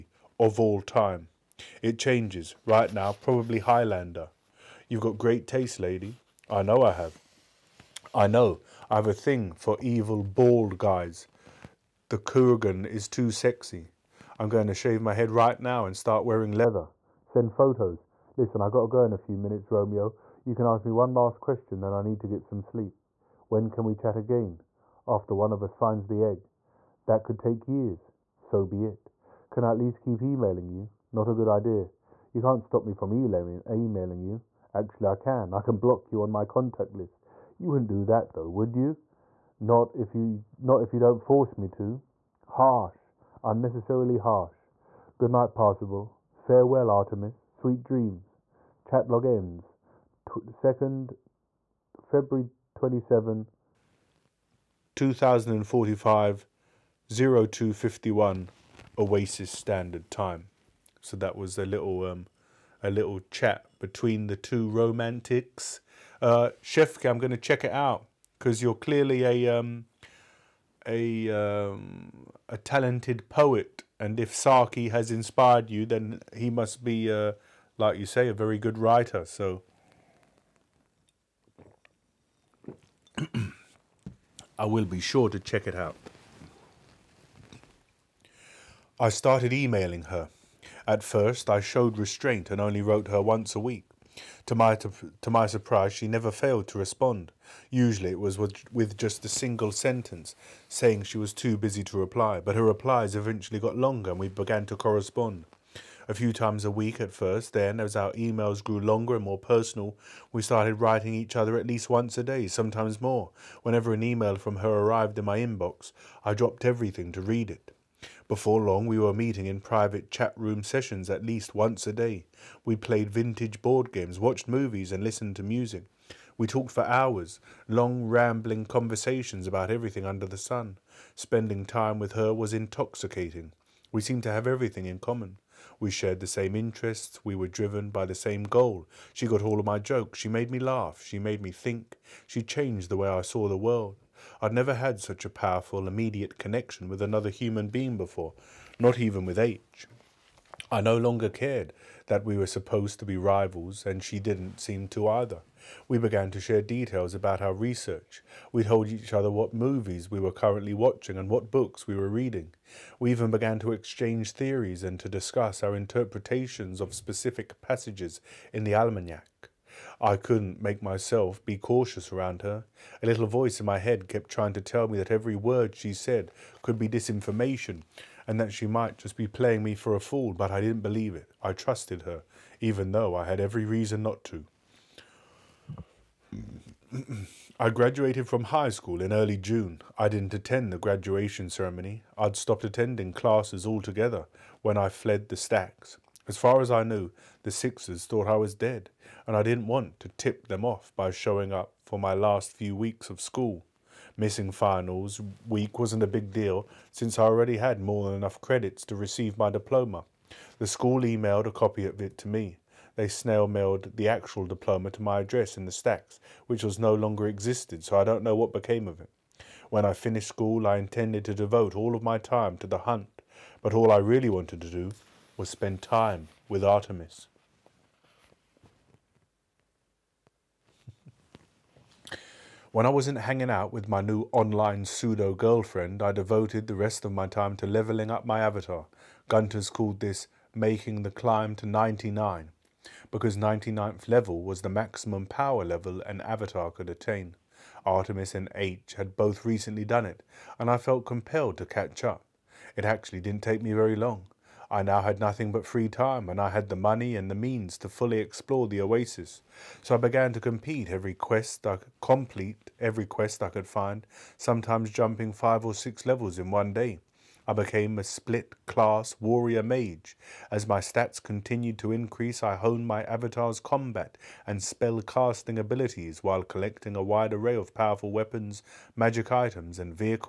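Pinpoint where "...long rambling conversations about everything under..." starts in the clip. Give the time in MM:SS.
02:07.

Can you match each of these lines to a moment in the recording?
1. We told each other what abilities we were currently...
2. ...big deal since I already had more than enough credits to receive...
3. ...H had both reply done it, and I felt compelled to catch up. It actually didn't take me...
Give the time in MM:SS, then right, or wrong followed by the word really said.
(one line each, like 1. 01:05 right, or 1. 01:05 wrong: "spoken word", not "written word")
1. 02:38 wrong: "movies", not "abilities"
2. 03:26 right
3. 04:08 wrong: "recently", not "reply".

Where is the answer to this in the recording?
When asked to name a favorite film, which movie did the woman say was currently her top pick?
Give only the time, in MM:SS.
00:03.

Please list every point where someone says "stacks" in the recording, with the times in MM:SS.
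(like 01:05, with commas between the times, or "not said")
03:15, 03:35.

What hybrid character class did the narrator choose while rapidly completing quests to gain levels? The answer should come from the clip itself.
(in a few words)
Split class warrior mage.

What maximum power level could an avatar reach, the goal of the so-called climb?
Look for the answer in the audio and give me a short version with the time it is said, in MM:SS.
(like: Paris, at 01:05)
99, at 04:01.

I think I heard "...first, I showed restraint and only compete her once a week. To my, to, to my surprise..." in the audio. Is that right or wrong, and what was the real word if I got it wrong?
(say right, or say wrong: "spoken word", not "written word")
wrong: "wrote", not "compete".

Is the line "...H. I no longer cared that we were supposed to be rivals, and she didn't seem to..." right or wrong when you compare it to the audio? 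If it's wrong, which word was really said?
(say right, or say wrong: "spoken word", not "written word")
right.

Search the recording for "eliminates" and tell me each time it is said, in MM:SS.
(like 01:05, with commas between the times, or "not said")
not said.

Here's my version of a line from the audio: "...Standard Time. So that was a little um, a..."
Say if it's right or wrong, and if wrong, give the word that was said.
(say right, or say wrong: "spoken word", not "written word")
right.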